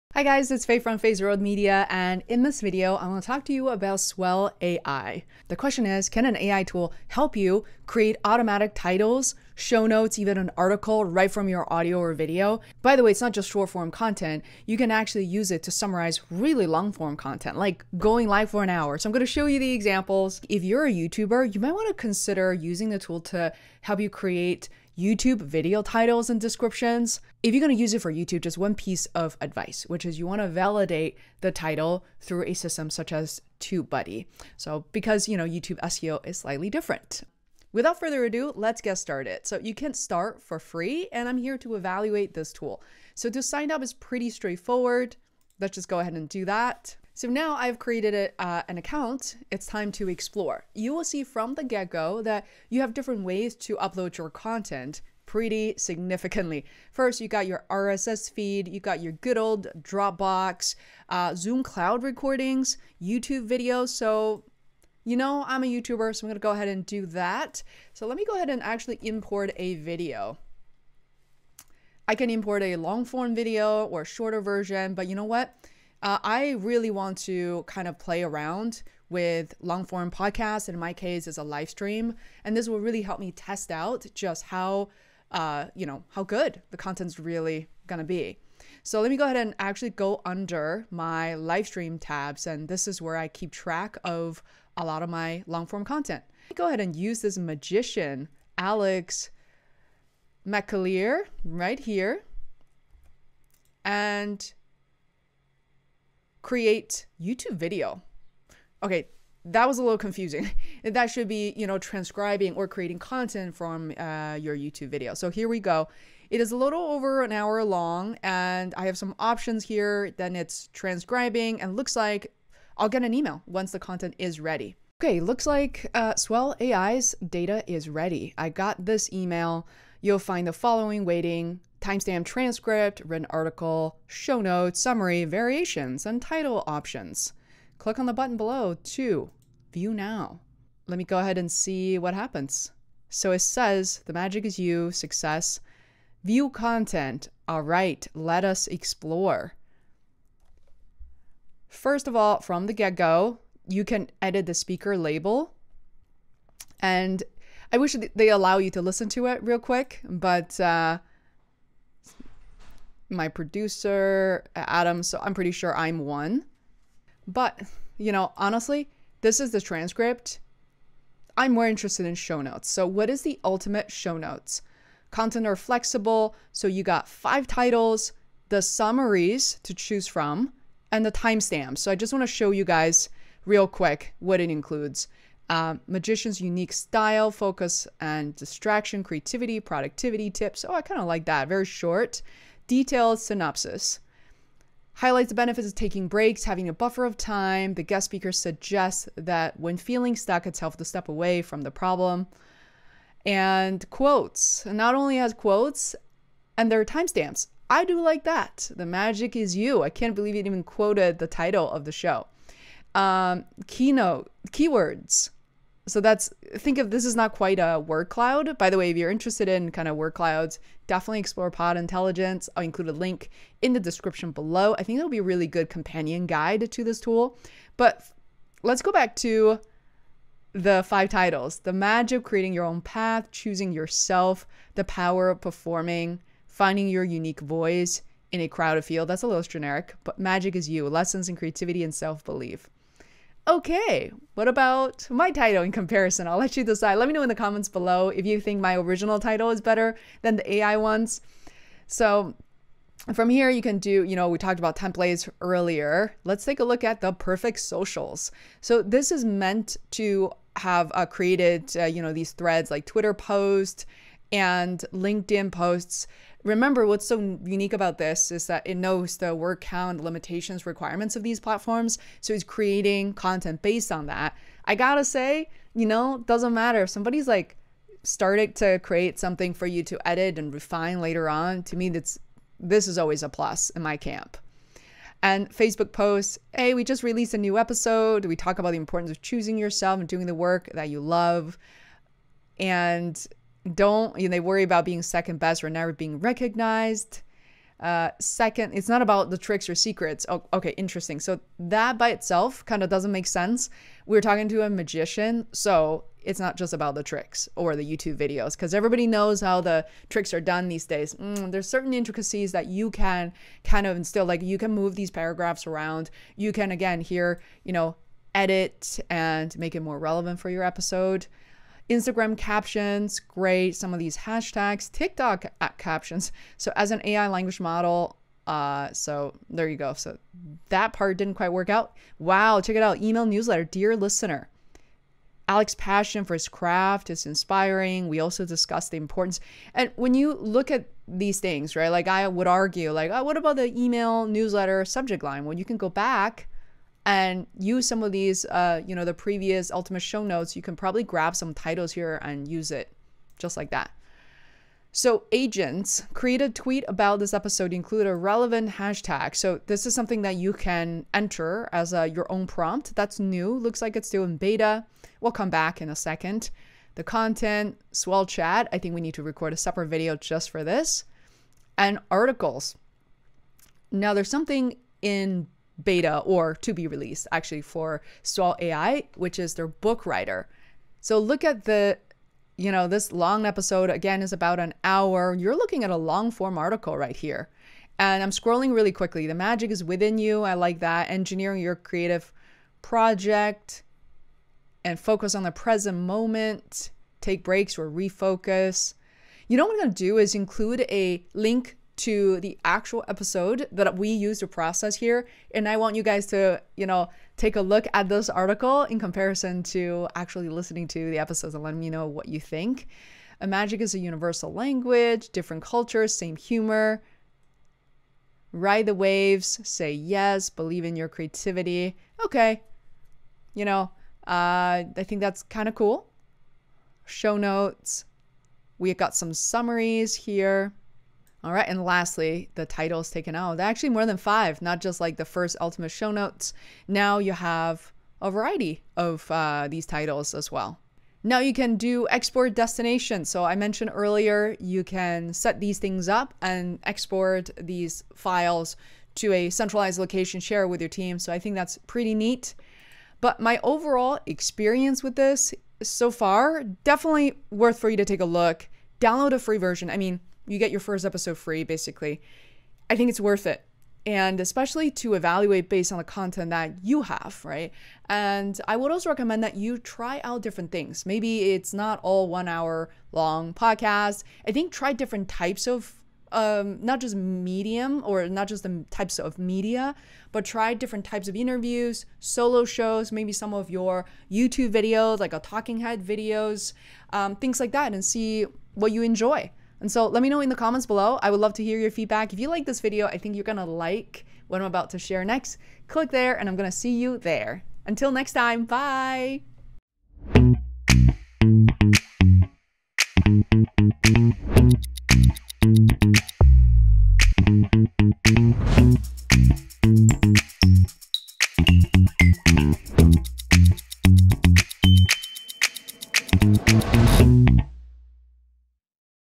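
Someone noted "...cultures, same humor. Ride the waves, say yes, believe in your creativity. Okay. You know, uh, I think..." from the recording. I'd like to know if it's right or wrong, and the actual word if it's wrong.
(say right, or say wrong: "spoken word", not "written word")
right.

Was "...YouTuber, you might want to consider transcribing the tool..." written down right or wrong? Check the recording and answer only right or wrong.
wrong.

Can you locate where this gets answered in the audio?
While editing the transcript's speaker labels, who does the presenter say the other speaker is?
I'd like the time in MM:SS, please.
02:43.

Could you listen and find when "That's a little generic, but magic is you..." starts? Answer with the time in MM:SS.
03:59.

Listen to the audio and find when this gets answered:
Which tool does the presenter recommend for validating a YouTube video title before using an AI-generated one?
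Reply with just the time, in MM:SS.
00:33.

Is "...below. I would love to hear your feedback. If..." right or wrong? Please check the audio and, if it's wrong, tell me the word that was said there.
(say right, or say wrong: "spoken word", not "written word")
right.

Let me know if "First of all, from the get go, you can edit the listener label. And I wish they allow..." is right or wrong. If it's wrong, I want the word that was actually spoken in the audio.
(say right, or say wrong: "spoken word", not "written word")
wrong: "speaker", not "listener".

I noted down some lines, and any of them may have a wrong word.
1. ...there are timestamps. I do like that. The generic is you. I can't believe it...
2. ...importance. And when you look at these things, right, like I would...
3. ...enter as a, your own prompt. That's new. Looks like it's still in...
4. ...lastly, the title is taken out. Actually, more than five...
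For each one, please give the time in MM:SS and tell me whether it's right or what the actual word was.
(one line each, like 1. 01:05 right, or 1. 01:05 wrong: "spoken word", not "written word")
1. 03:26 wrong: "magic", not "generic"
2. 05:38 right
3. 06:01 right
4. 07:11 right.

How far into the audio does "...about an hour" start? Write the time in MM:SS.
06:24.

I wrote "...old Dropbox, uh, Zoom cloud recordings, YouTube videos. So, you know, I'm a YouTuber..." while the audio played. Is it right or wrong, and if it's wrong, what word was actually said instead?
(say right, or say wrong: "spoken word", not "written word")
right.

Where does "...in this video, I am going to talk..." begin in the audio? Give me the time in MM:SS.
00:02.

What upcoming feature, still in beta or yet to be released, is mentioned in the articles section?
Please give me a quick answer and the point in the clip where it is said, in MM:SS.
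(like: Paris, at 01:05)
book writer, at 06:19.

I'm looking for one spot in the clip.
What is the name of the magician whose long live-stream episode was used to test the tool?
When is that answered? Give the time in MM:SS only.
01:38.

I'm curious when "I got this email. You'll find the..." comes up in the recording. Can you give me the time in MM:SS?
02:08.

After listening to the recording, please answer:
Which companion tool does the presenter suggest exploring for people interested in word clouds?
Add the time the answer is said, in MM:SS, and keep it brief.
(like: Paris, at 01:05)
Pod Intelligence, at 03:41.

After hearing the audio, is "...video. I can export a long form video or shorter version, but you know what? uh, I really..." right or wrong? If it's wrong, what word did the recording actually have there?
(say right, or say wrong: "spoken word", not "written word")
wrong: "import", not "export".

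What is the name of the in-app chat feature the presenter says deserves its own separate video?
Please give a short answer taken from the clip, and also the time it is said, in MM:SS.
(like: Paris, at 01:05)
swell chat, at 06:07.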